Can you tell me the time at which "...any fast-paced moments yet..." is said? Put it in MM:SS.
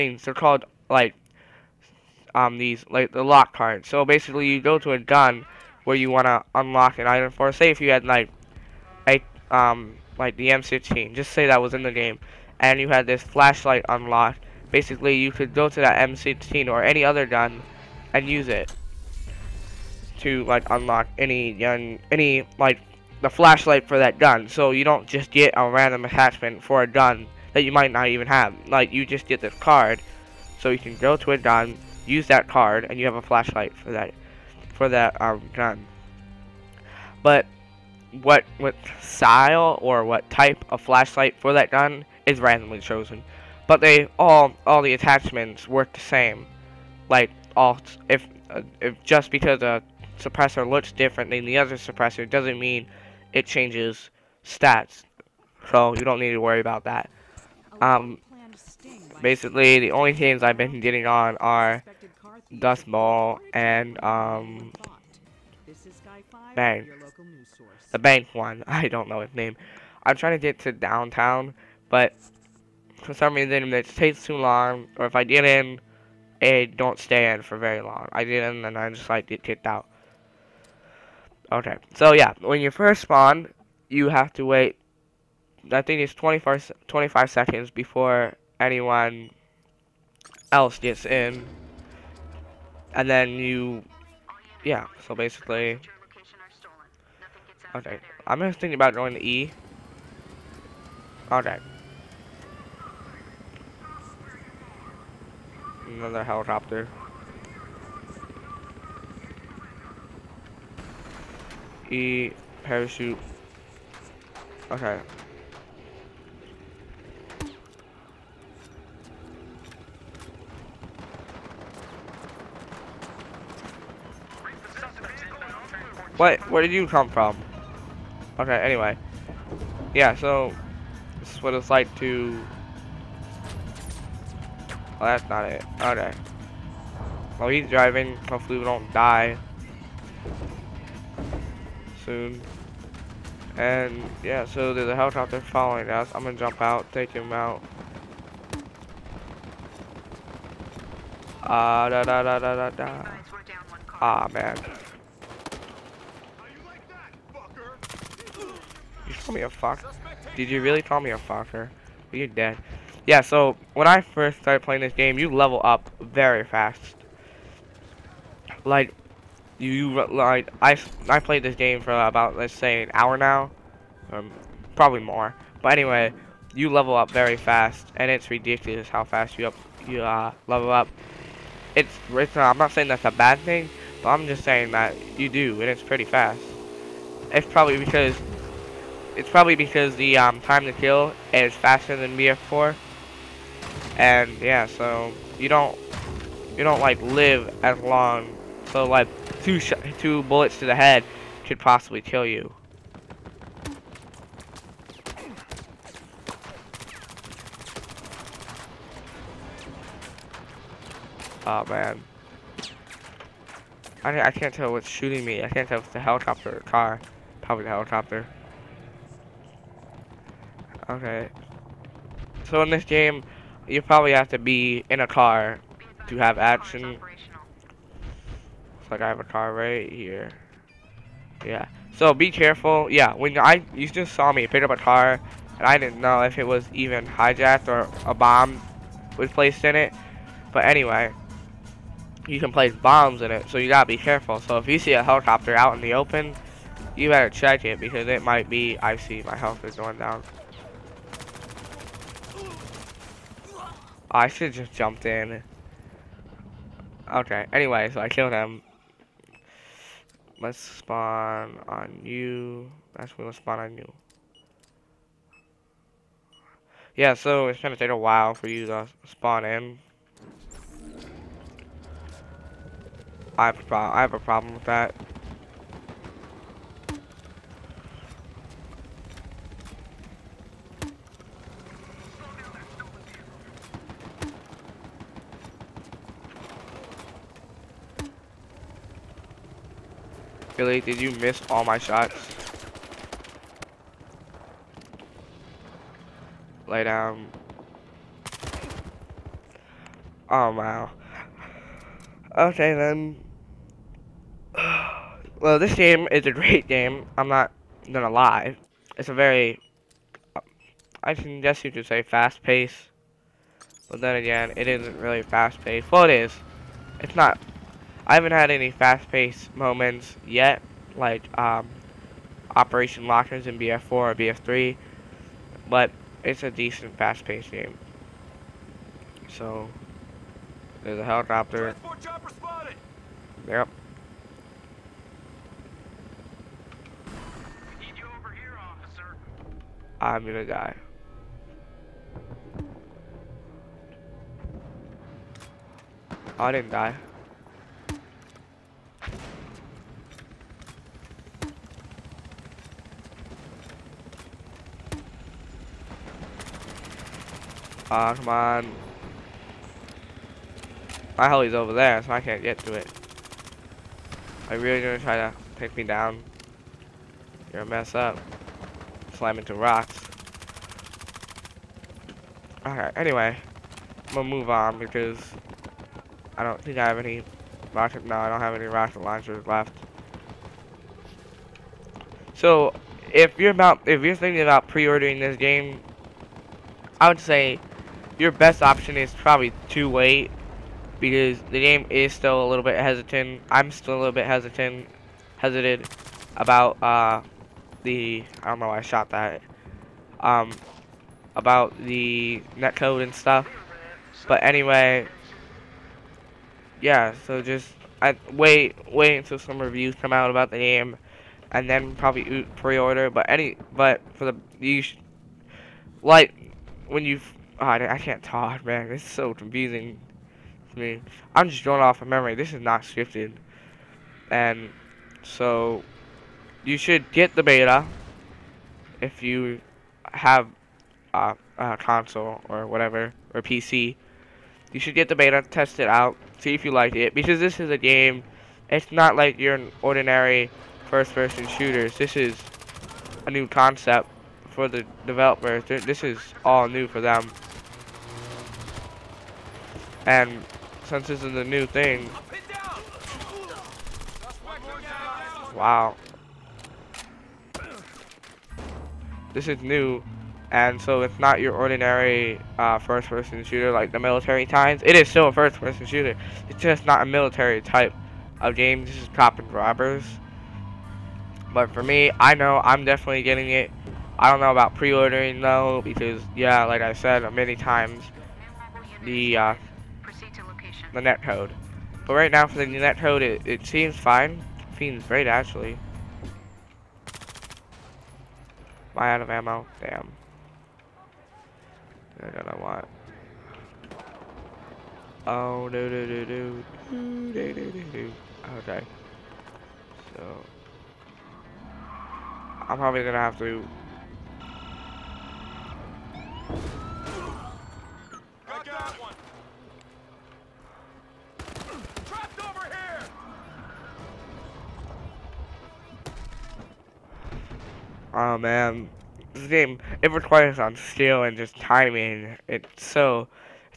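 05:18.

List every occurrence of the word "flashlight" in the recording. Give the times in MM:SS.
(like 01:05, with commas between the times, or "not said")
00:13, 00:23, 00:33, 00:40.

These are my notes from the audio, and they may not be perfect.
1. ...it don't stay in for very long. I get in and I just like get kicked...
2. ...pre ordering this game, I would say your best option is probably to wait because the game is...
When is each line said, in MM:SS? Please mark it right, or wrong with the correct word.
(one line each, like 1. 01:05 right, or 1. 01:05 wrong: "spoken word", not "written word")
1. 01:16 right
2. 06:24 right.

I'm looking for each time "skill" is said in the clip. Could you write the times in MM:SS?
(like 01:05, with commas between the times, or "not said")
08:40.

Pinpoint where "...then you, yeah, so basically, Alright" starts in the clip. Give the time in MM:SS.
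01:33.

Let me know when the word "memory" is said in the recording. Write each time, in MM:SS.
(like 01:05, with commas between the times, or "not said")
07:02.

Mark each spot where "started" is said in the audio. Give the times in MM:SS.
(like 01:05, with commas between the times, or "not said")
02:44.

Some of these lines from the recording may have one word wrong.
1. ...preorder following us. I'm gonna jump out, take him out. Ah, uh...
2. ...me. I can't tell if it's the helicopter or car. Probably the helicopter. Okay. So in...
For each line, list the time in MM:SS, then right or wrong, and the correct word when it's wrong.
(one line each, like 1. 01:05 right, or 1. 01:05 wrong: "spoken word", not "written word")
1. 02:24 wrong: "helicopter", not "preorder"
2. 03:35 right.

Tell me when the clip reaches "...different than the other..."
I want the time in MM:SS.
00:50.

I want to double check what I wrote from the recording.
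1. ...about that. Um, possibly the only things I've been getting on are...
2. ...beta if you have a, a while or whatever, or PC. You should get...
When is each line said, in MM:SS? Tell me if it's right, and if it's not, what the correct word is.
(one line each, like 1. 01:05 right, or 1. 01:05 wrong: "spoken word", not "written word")
1. 00:56 wrong: "basically", not "possibly"
2. 07:07 wrong: "console", not "while".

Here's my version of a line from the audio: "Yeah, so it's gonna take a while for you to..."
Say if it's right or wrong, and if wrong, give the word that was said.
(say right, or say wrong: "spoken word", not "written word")
right.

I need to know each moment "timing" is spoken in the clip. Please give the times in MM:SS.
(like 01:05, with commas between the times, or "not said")
08:41.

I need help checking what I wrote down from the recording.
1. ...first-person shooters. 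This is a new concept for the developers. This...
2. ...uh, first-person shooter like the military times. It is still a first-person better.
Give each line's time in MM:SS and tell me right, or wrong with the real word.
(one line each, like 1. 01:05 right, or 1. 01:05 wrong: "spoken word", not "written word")
1. 07:20 right
2. 07:42 wrong: "shooter", not "better".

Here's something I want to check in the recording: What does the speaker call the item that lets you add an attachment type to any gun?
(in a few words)
lock cards.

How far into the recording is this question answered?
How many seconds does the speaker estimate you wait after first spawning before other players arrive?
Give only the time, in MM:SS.
01:26.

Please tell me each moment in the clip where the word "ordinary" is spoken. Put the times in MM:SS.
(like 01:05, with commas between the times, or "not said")
07:19, 07:41.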